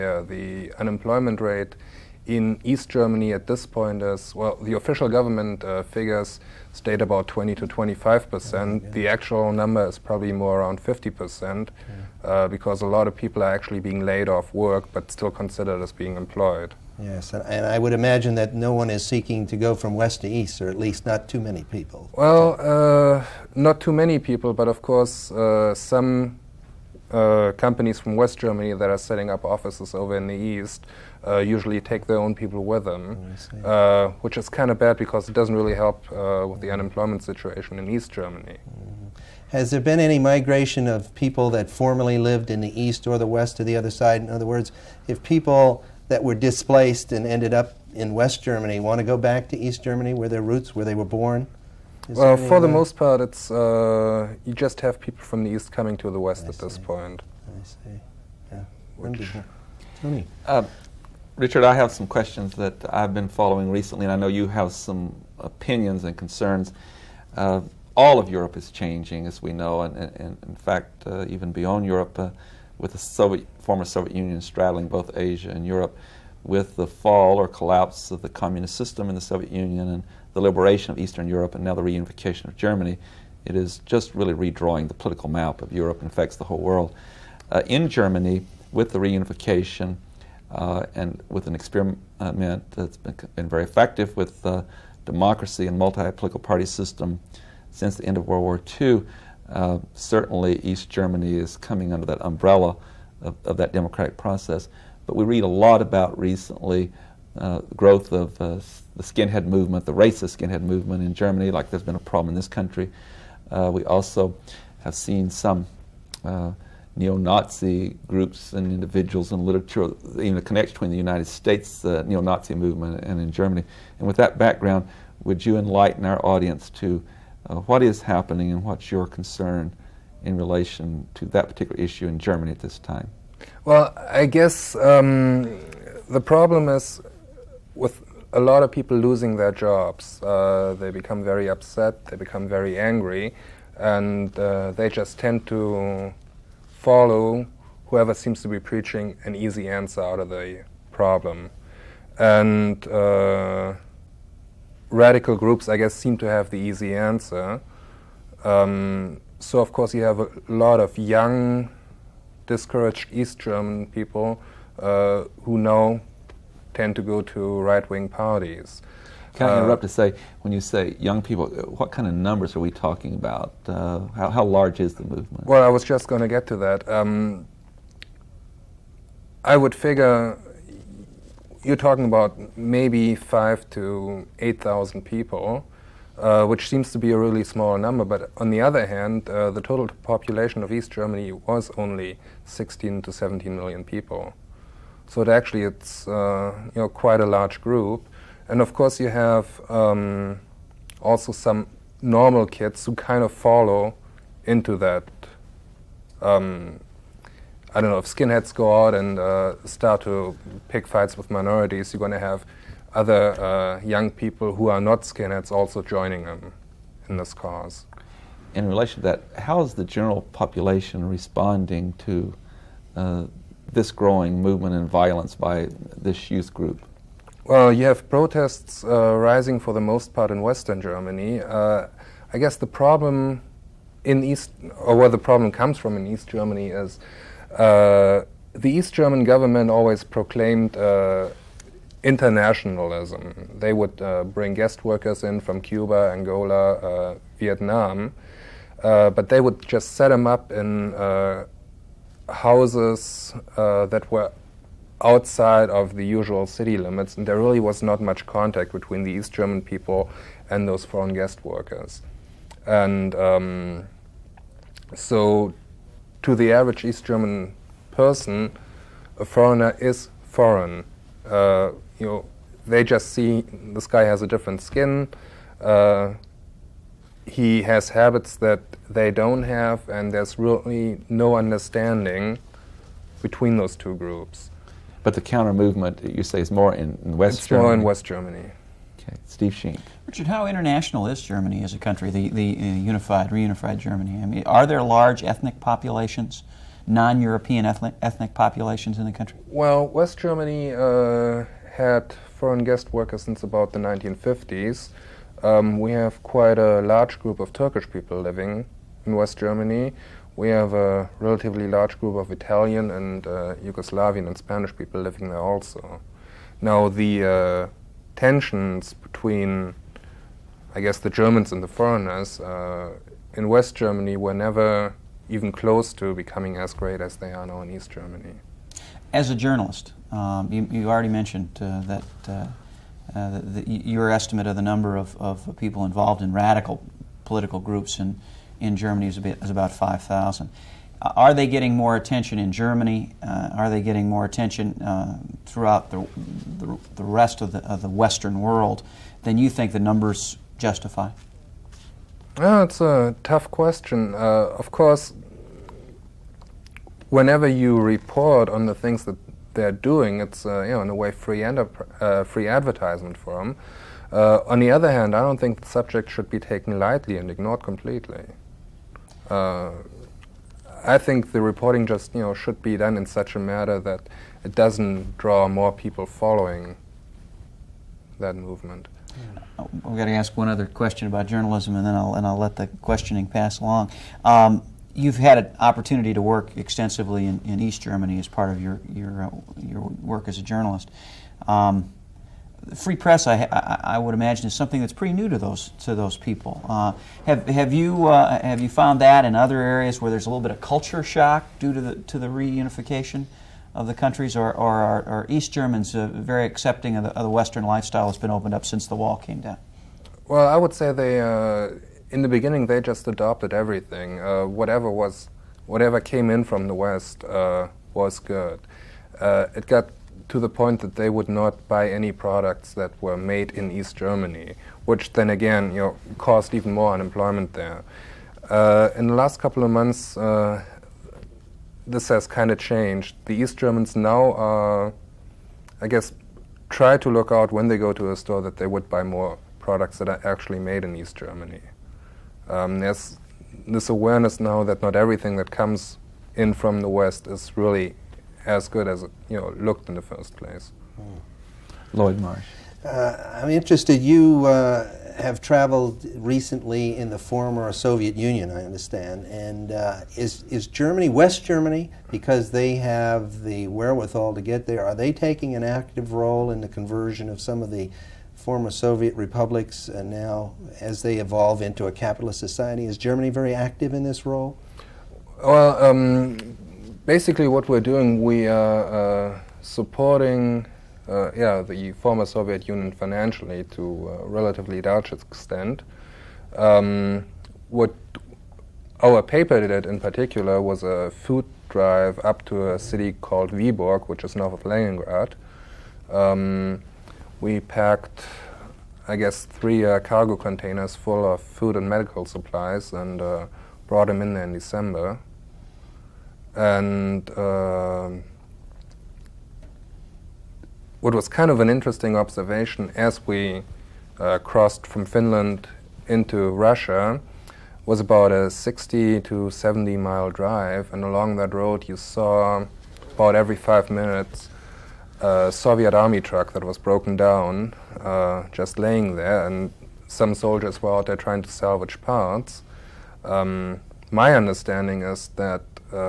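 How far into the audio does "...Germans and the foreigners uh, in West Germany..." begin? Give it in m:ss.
5:21.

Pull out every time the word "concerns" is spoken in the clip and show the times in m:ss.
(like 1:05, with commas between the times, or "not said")
1:06, 2:09.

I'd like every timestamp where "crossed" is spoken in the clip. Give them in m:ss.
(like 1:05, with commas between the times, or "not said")
8:34.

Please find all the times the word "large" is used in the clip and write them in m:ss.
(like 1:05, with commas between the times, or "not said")
2:54, 3:17, 4:54, 5:06, 5:11, 8:04.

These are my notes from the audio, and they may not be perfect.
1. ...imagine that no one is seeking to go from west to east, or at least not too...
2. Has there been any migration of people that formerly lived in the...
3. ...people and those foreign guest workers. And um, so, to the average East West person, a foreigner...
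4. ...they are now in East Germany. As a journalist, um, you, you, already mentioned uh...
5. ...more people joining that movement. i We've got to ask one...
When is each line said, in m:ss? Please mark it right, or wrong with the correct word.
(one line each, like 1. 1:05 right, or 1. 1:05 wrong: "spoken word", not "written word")
1. 0:17 right
2. 0:39 right
3. 4:19 wrong: "German", not "West"
4. 5:27 right
5. 6:15 wrong: "following", not "joining".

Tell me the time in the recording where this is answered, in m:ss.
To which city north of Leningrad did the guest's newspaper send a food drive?
8:13.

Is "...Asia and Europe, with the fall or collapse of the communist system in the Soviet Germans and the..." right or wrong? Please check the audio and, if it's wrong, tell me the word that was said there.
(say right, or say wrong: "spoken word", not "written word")
wrong: "Union", not "Germans".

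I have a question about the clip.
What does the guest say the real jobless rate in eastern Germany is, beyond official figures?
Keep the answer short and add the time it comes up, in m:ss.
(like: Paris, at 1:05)
50 percent, at 0:10.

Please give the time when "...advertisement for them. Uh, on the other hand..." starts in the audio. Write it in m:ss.
6:02.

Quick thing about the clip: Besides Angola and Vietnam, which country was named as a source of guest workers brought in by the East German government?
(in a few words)
Cuba.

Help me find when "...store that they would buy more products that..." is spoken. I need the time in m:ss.
7:18.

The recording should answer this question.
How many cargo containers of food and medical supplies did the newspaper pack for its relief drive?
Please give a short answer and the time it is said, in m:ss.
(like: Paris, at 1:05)
3, at 8:19.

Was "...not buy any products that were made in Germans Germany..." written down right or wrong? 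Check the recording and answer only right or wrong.
wrong.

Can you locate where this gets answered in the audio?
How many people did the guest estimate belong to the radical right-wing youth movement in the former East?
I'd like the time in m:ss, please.
3:03.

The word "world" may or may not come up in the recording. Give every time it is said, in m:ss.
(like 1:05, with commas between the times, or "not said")
1:26, 1:38, 5:48.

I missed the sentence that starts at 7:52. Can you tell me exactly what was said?
Is Germany very active in this role?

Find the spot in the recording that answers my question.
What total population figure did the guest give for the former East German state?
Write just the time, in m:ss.
3:12.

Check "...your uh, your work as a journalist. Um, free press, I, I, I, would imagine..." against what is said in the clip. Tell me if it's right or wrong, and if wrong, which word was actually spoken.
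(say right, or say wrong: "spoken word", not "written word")
right.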